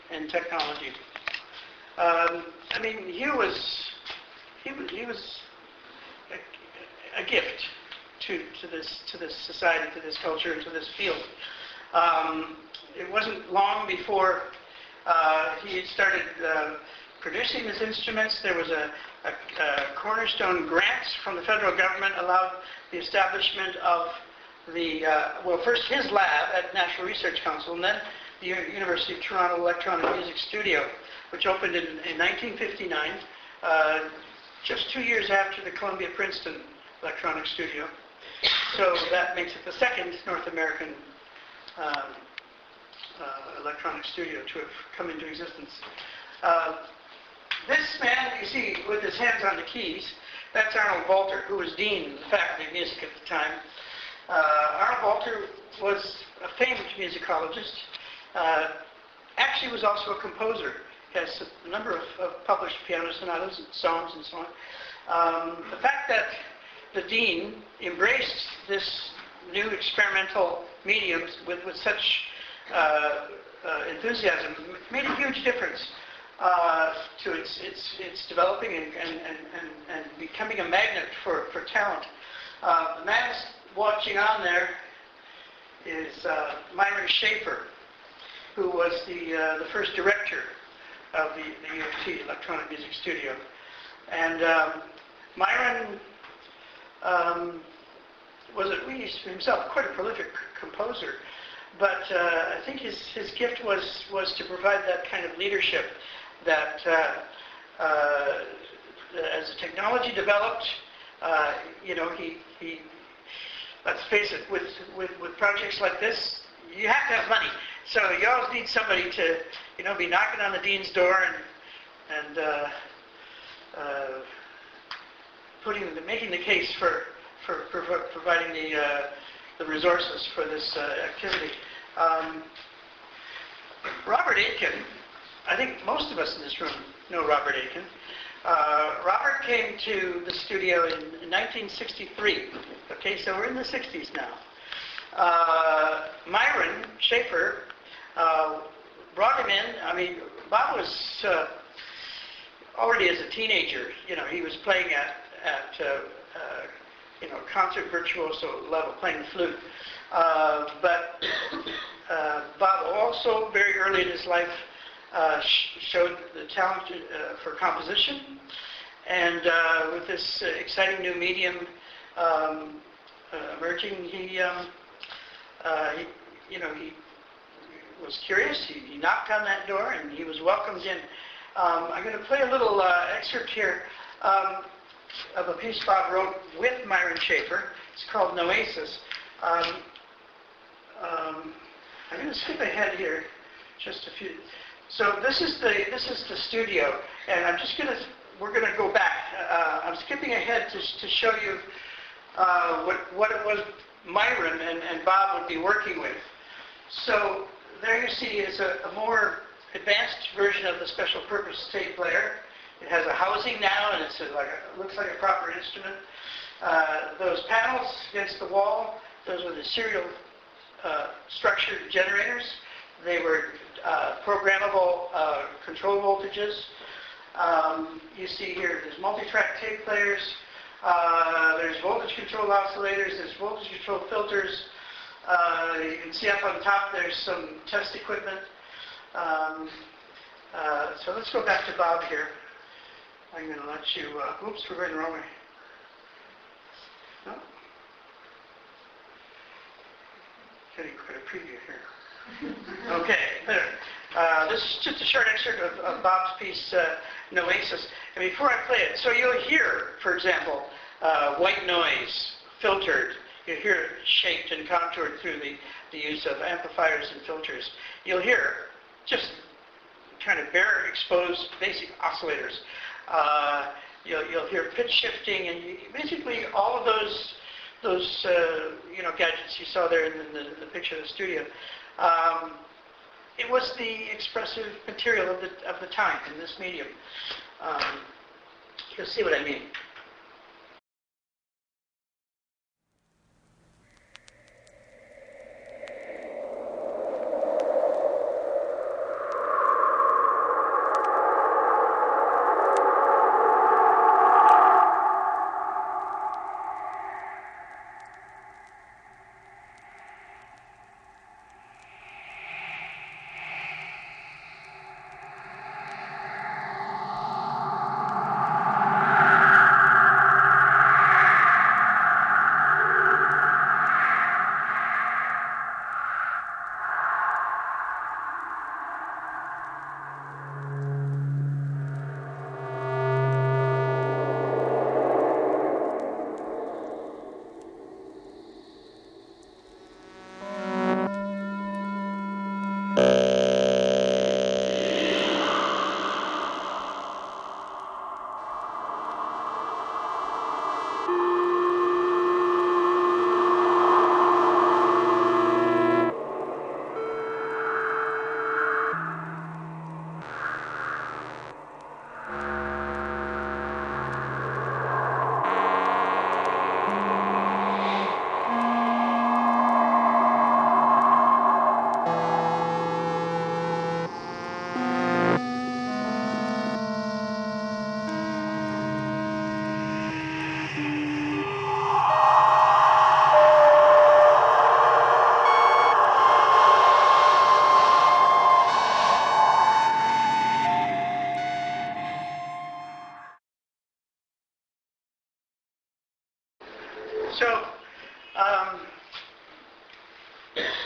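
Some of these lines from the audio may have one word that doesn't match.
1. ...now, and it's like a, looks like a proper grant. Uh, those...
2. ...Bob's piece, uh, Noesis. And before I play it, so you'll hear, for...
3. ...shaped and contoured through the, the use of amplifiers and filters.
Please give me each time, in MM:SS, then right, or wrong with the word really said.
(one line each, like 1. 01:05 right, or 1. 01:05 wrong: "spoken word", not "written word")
1. 03:33 wrong: "instrument", not "grant"
2. 04:16 right
3. 04:24 right.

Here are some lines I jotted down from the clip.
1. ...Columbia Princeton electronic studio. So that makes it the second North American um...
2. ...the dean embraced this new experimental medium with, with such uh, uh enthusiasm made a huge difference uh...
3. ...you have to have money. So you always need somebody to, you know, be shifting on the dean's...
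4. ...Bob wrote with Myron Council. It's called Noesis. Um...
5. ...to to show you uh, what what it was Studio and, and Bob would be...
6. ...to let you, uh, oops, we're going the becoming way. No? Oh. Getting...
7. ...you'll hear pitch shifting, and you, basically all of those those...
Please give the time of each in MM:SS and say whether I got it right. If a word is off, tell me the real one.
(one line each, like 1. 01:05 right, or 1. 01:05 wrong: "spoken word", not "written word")
1. 00:35 right
2. 01:06 right
3. 01:56 wrong: "knocking", not "shifting"
4. 03:05 wrong: "Schaefer", not "Council"
5. 03:20 wrong: "Myron", not "Studio"
6. 04:03 wrong: "wrong", not "becoming"
7. 04:34 right.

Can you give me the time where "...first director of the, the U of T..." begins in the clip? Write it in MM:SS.
01:29.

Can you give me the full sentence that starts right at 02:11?
Um, Robert Aitken, I think most of us in this room know Robert Aitken.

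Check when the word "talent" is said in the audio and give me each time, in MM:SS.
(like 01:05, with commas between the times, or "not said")
01:21, 02:46.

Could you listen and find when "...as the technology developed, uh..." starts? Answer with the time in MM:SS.
01:49.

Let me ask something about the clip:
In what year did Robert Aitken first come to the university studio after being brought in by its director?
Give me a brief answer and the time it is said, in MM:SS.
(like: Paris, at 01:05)
1963, at 02:21.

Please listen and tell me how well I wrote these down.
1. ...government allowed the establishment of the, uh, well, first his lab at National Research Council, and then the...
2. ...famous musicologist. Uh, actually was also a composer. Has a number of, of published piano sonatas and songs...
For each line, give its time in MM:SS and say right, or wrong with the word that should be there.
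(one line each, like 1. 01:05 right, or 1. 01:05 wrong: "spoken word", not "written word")
1. 00:21 right
2. 00:56 right.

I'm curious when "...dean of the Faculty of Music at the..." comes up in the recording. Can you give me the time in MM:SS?
00:51.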